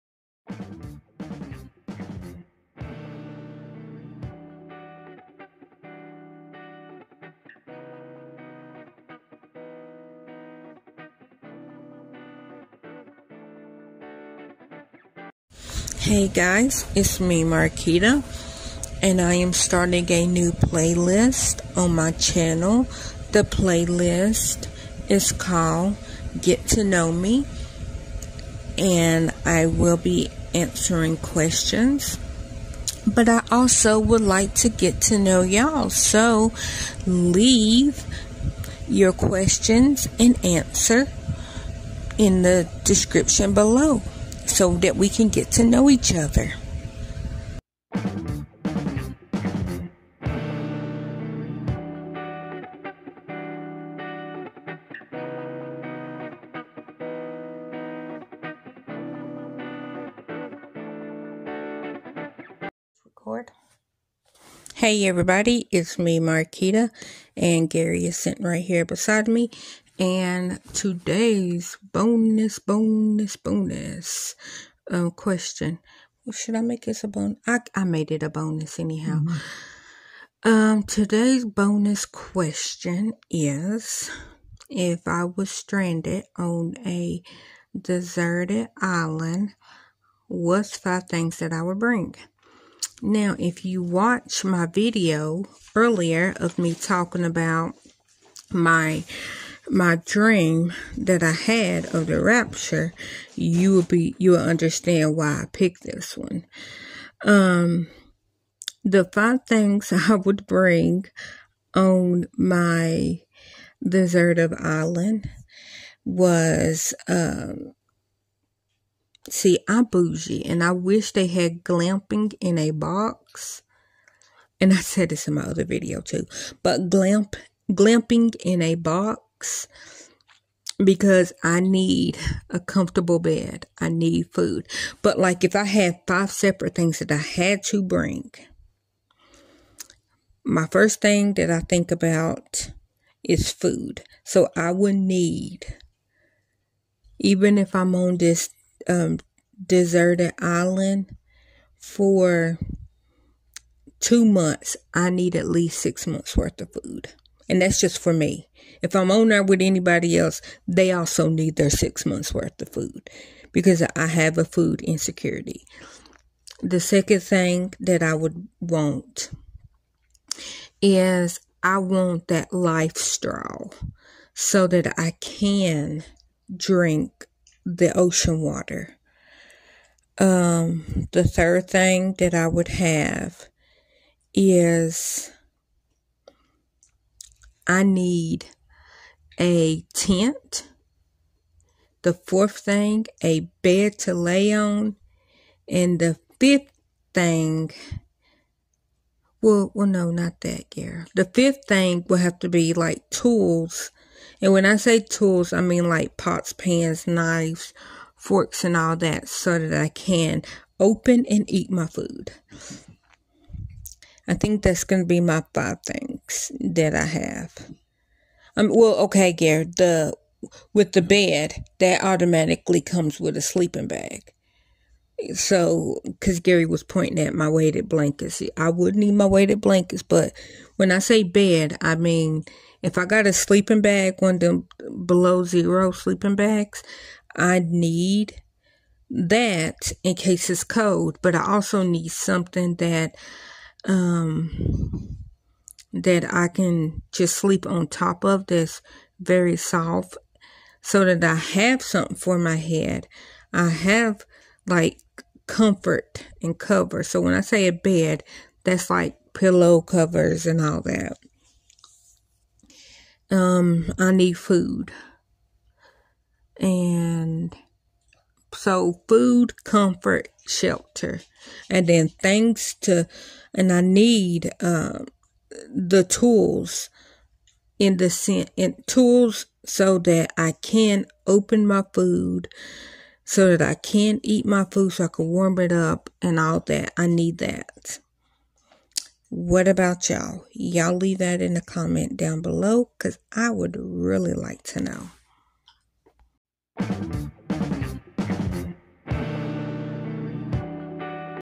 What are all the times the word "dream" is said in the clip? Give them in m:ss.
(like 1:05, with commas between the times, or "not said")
1:40.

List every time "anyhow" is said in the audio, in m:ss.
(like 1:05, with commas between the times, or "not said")
1:18.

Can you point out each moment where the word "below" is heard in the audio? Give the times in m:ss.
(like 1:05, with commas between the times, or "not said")
0:43, 3:55, 4:52.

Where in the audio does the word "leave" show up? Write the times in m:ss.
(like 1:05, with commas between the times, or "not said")
0:37, 4:50.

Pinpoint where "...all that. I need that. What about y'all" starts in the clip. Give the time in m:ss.
4:46.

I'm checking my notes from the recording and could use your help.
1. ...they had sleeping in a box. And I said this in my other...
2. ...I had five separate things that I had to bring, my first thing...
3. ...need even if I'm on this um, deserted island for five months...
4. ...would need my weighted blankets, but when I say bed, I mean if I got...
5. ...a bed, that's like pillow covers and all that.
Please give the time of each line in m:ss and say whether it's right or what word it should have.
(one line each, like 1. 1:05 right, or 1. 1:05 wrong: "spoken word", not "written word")
1. 2:01 wrong: "glamping", not "sleeping"
2. 2:15 right
3. 2:24 wrong: "two", not "five"
4. 3:48 right
5. 4:17 right.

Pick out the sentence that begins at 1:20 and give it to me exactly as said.
Um, today's bonus question is if I was stranded on a deserted island, what's five things that I would bring?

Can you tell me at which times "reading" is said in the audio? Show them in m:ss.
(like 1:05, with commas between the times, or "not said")
not said.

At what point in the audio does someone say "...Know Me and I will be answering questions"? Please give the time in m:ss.
0:26.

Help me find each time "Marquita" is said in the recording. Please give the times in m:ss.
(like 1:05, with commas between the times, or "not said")
0:17, 1:06.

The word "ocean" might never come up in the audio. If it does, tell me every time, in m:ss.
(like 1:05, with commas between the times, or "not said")
2:57.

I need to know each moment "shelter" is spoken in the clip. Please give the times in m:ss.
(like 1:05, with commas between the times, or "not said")
4:30.